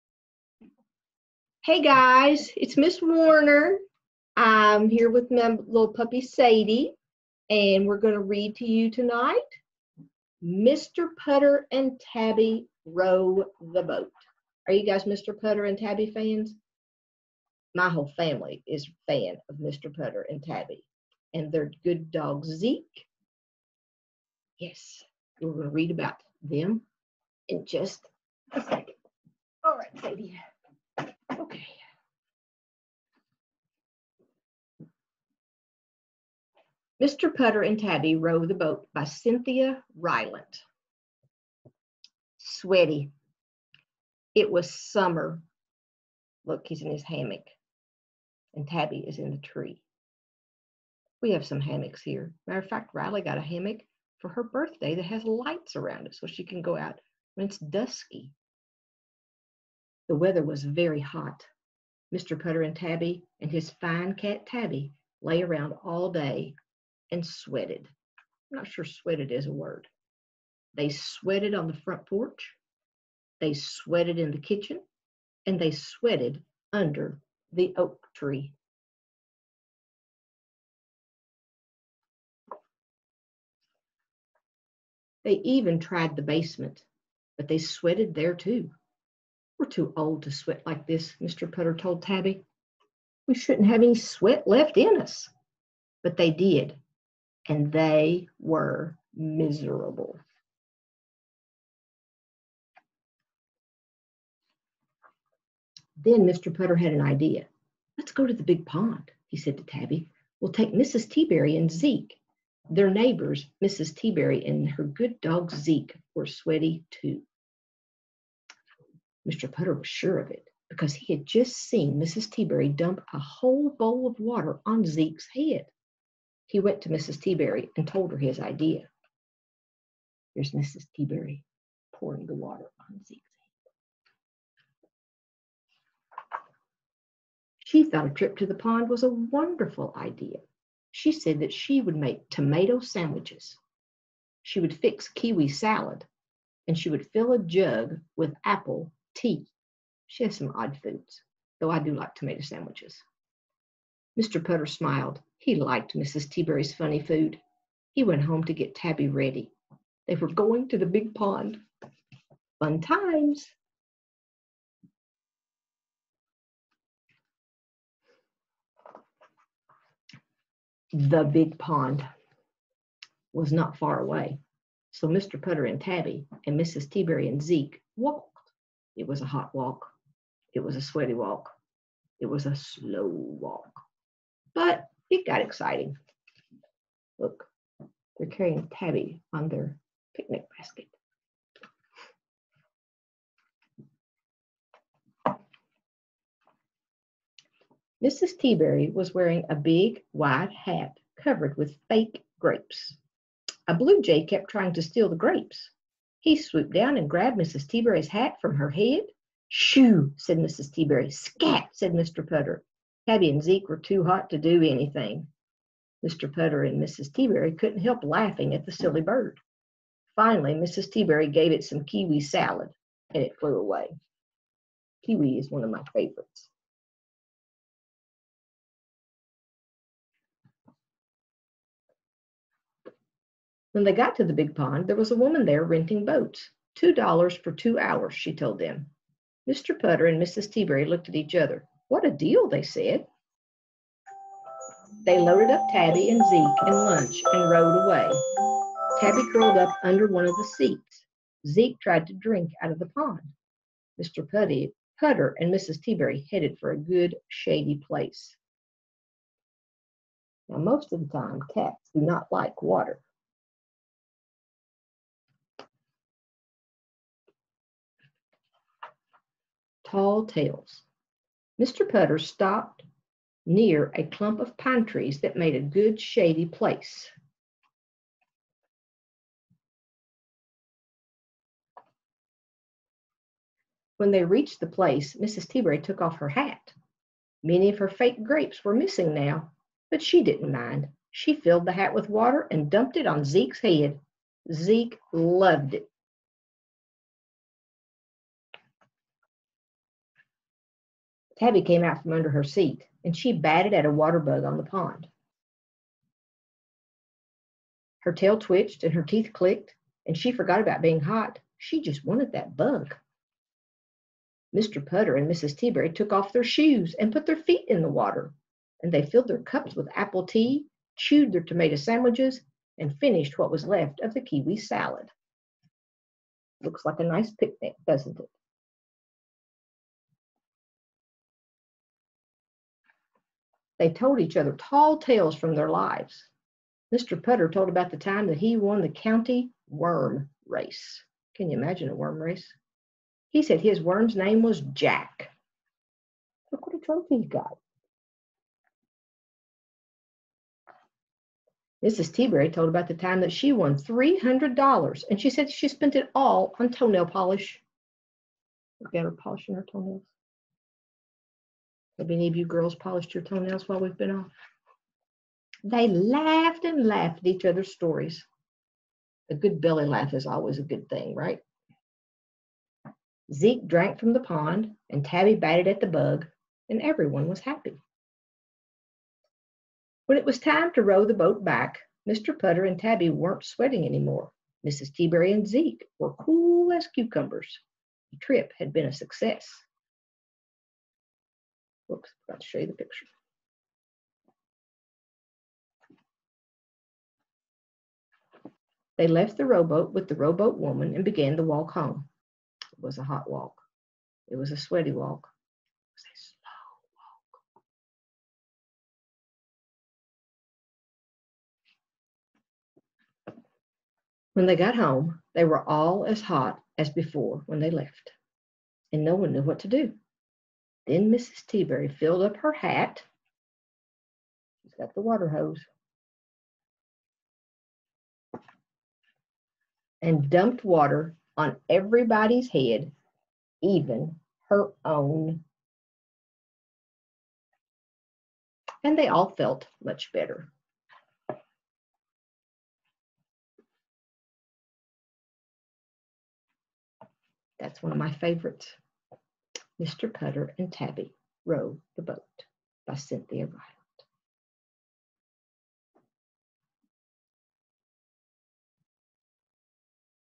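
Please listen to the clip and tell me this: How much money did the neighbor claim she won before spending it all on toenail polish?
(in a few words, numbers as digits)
$300.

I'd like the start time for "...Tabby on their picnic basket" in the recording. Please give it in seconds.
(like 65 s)
188 s.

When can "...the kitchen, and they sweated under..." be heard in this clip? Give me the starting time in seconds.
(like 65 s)
74 s.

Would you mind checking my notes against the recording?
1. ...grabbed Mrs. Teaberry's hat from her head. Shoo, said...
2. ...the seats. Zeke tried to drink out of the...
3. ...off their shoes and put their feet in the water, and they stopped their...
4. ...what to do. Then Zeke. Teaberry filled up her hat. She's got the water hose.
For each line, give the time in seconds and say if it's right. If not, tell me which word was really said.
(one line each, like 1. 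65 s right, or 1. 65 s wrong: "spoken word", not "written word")
1. 207 s right
2. 250 s right
3. 316 s wrong: "filled", not "stopped"
4. 419 s wrong: "Mrs", not "Zeke".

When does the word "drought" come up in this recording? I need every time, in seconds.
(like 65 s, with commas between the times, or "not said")
not said.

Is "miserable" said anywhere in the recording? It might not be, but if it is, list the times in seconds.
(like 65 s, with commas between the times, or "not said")
99 s.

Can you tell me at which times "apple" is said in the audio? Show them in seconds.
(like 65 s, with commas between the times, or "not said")
148 s, 319 s.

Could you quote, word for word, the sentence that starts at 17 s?
My whole family is a fan of Mr.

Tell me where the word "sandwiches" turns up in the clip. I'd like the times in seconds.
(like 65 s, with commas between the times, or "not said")
142 s, 152 s, 321 s.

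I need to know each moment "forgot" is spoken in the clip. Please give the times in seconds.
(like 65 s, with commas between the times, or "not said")
310 s, 392 s.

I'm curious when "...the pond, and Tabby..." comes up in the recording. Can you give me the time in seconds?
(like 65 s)
374 s.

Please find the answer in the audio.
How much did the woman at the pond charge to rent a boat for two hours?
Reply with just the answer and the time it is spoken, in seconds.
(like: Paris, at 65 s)
$2, at 236 s.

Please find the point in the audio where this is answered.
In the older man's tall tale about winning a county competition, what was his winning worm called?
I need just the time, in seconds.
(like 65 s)
344 s.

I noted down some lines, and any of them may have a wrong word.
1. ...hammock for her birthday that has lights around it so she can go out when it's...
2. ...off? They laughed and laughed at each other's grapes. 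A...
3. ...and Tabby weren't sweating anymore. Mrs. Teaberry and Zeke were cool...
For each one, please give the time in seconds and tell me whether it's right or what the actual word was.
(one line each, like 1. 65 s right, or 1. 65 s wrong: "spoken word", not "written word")
1. 53 s right
2. 364 s wrong: "stories", not "grapes"
3. 382 s right.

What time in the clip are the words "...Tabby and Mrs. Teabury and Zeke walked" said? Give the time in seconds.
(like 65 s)
175 s.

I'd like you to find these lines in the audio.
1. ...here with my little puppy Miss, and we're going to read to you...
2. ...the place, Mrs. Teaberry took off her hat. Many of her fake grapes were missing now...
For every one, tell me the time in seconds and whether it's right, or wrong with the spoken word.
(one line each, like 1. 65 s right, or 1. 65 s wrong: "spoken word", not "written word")
1. 4 s wrong: "Sadie", not "Miss"
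2. 284 s right.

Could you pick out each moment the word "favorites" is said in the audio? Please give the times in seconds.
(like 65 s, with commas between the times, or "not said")
225 s, 448 s.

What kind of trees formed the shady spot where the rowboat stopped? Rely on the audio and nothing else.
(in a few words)
Pine trees.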